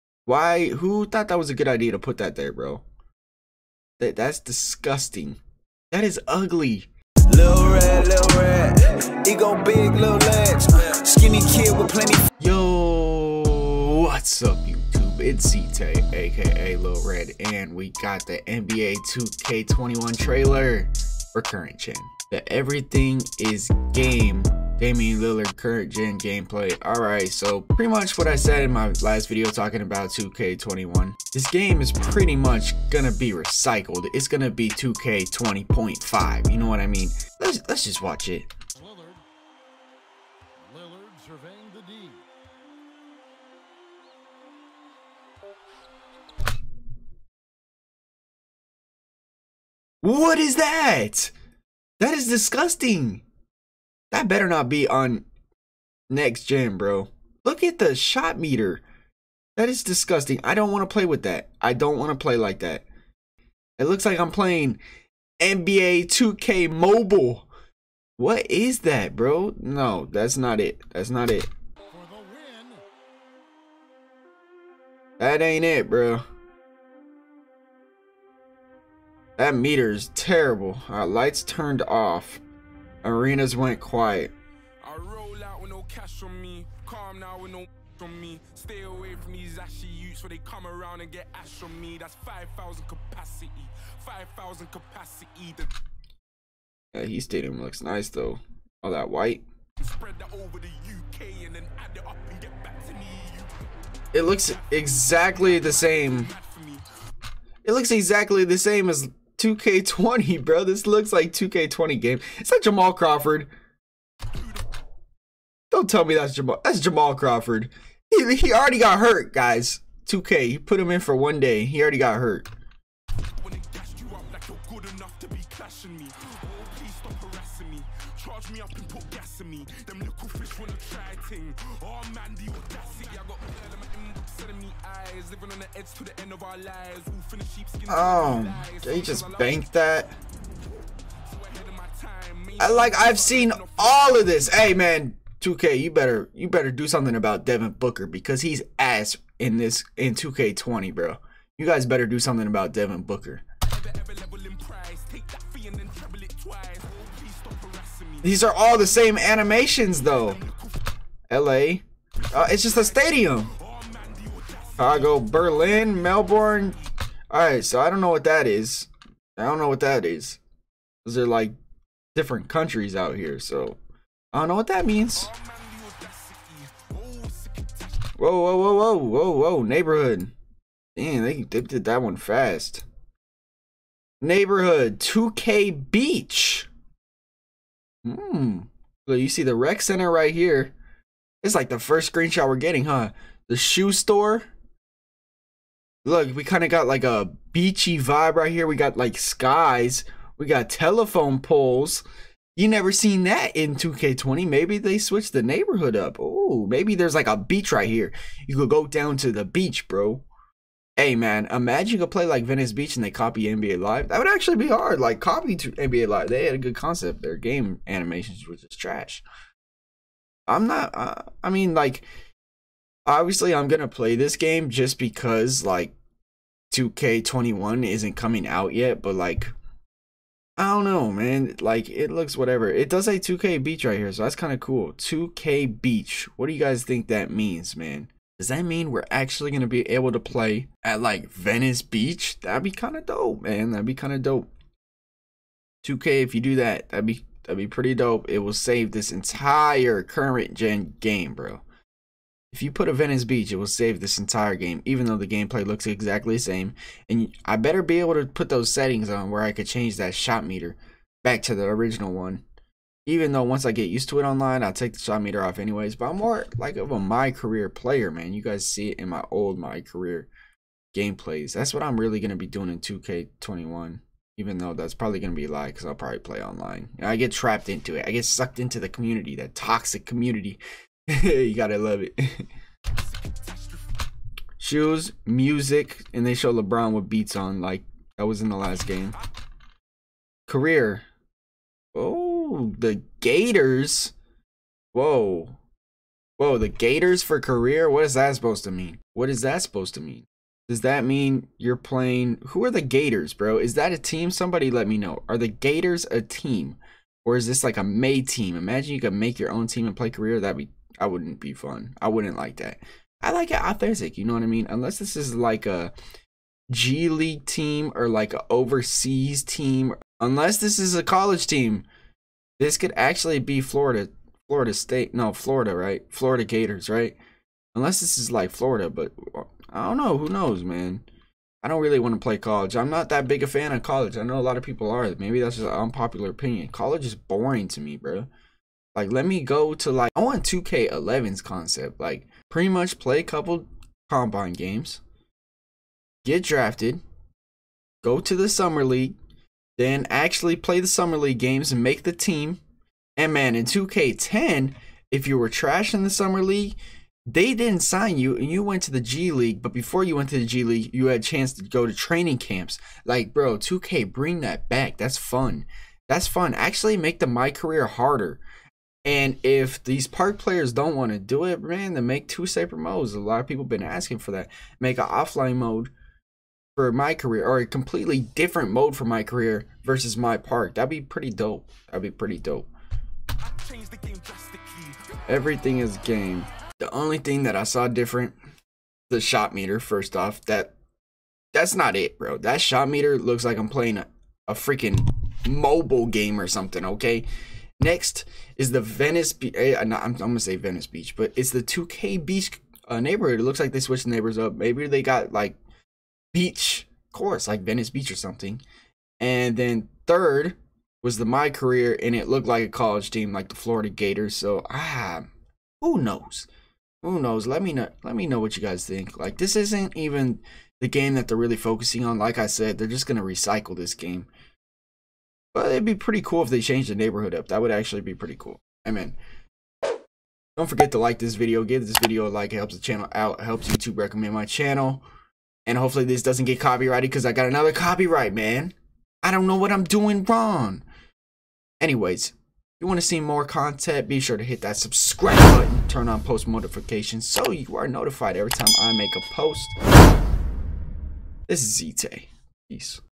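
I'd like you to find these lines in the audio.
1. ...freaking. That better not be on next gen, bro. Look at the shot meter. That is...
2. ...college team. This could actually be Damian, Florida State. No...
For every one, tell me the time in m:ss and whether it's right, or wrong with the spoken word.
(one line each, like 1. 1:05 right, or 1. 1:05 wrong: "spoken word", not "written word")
1. 0:52 wrong: "disgusting", not "freaking"
2. 5:21 wrong: "Florida", not "Damian".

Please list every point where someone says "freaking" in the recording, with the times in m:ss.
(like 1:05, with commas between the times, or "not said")
6:34.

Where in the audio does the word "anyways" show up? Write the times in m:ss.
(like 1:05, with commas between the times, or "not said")
4:25, 7:21.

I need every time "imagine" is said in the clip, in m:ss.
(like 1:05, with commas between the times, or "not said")
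3:31, 5:08.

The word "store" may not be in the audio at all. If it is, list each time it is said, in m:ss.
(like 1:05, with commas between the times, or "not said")
3:13.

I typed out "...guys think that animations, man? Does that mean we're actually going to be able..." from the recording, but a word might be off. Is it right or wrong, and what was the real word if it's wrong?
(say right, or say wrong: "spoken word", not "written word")
wrong: "means", not "animations".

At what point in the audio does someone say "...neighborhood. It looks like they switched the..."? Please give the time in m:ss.
6:42.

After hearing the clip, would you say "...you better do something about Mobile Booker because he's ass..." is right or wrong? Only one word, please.
wrong.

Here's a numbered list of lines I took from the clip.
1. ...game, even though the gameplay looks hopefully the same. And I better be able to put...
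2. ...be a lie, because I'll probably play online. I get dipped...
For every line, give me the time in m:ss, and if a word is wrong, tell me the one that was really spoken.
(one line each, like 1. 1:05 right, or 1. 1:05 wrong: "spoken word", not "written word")
1. 4:14 wrong: "exactly", not "hopefully"
2. 4:35 wrong: "trapped", not "dipped".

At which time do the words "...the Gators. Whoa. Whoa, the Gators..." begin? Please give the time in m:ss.
4:52.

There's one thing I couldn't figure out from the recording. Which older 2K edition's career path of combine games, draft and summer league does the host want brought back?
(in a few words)
2K11.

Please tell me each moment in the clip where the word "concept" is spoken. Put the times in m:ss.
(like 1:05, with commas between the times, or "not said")
3:36, 5:41.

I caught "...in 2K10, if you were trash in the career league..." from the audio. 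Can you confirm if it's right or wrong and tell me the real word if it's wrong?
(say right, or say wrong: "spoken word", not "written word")
wrong: "summer", not "career".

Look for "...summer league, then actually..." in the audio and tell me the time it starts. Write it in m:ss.
5:48.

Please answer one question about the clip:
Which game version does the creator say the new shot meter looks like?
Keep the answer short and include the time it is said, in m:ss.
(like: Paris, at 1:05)
NBA 2K Mobile, at 1:05.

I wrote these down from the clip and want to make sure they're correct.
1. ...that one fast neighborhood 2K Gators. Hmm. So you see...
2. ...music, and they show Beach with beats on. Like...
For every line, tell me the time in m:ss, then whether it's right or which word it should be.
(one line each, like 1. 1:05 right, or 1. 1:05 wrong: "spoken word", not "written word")
1. 3:01 wrong: "Beach", not "Gators"
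2. 4:45 wrong: "LeBron", not "Beach".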